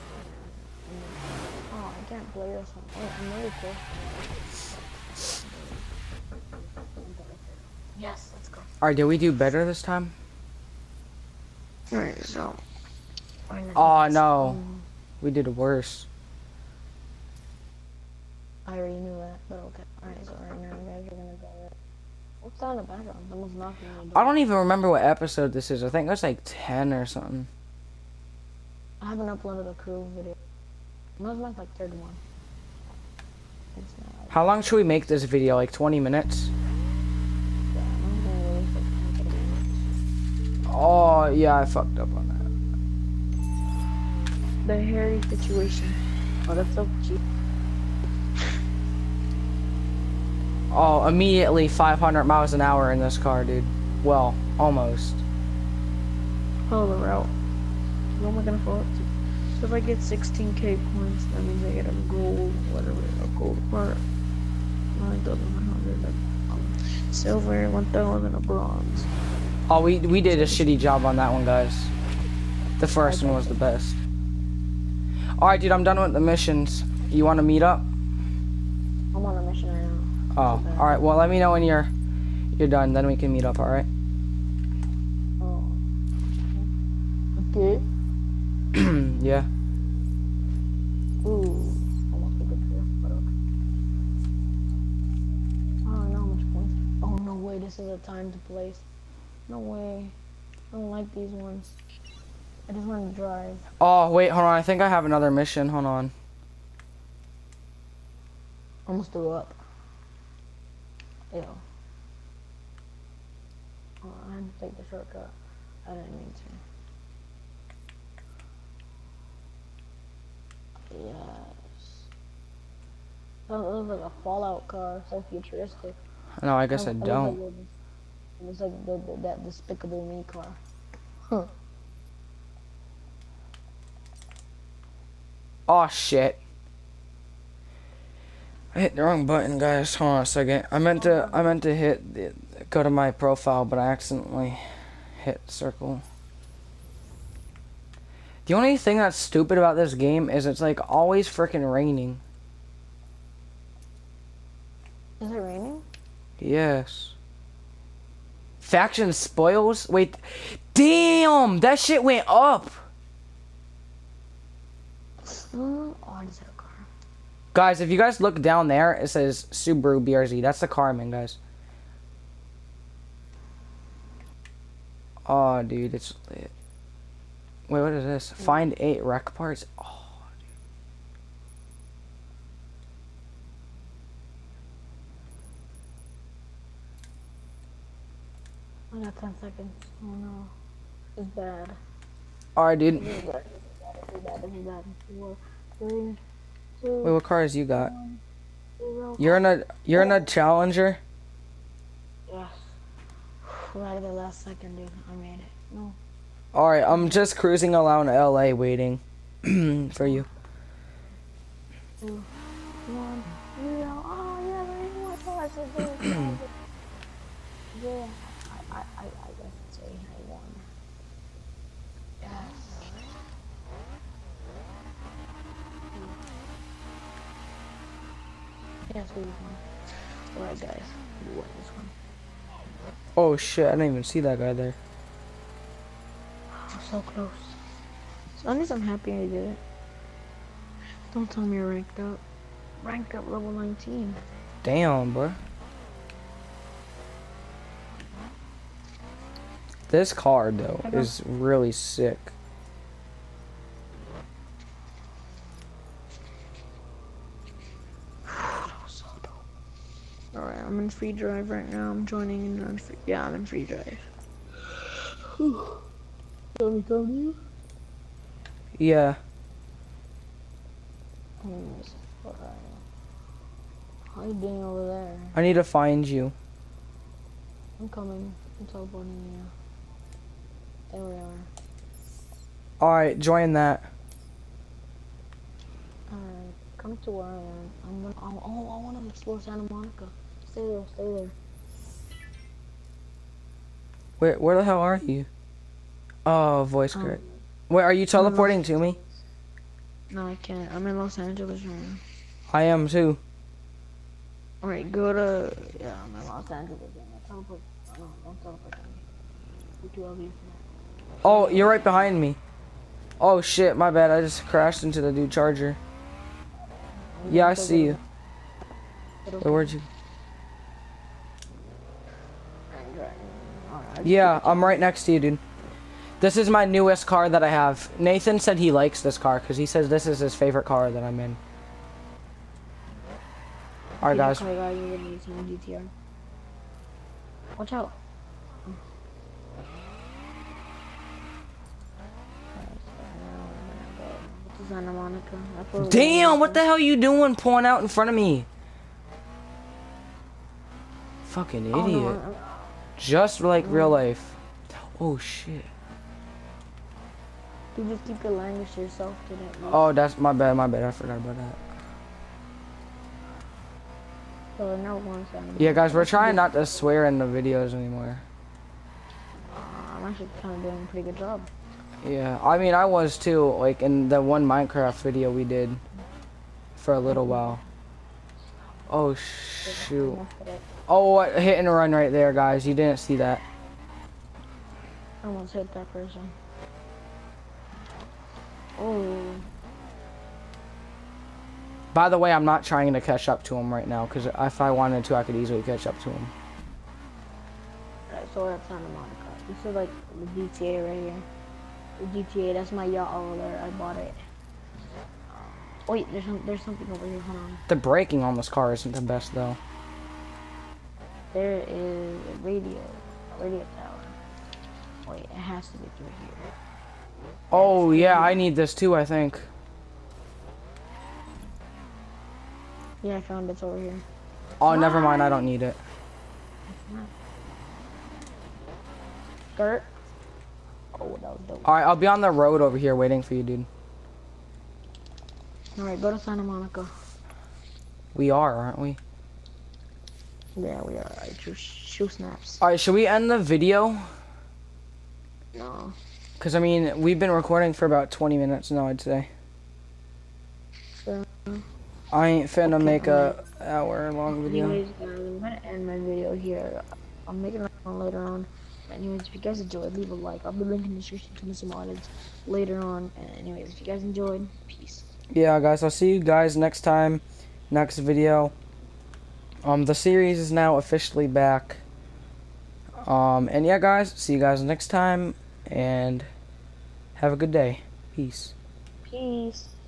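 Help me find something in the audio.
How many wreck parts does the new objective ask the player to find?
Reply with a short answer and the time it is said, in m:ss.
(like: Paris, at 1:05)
8, at 2:58.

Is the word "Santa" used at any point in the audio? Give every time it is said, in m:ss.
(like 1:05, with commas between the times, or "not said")
4:49, 7:16.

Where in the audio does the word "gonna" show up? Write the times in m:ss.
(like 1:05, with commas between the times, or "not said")
0:38, 0:58, 4:48, 7:35.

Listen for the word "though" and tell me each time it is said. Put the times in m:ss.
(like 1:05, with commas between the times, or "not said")
4:10, 6:49.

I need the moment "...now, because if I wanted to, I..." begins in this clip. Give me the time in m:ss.
6:33.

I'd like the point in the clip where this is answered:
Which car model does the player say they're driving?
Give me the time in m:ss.
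2:49.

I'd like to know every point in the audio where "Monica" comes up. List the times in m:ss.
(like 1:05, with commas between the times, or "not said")
4:49, 6:38, 7:16.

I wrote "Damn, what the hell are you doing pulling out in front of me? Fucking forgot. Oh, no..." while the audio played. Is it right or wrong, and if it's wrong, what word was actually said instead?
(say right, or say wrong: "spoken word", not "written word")
wrong: "idiot", not "forgot".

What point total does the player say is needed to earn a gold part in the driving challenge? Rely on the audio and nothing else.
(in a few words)
16k.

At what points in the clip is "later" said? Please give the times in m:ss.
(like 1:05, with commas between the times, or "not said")
7:37, 7:42.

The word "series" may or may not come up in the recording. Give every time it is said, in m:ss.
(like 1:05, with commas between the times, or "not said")
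7:49.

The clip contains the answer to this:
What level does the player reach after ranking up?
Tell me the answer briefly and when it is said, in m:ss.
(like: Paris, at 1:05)
19, at 4:03.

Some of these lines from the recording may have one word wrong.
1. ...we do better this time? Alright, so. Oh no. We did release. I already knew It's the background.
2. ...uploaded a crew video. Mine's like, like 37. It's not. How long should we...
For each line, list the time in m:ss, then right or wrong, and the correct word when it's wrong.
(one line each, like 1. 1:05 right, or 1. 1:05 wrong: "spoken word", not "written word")
1. 0:09 wrong: "worse", not "release"
2. 0:29 wrong: "31", not "37".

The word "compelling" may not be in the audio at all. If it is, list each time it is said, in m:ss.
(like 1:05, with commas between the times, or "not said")
not said.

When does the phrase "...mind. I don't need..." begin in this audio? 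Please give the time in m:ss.
7:04.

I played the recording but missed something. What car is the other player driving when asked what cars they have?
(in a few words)
Challenger.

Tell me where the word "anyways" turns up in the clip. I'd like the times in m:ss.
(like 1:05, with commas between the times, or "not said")
7:34, 7:38, 7:43.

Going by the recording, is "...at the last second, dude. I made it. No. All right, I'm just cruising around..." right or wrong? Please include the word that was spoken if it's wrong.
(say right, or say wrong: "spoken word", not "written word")
right.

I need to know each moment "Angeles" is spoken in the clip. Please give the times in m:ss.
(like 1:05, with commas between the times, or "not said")
5:01, 5:06.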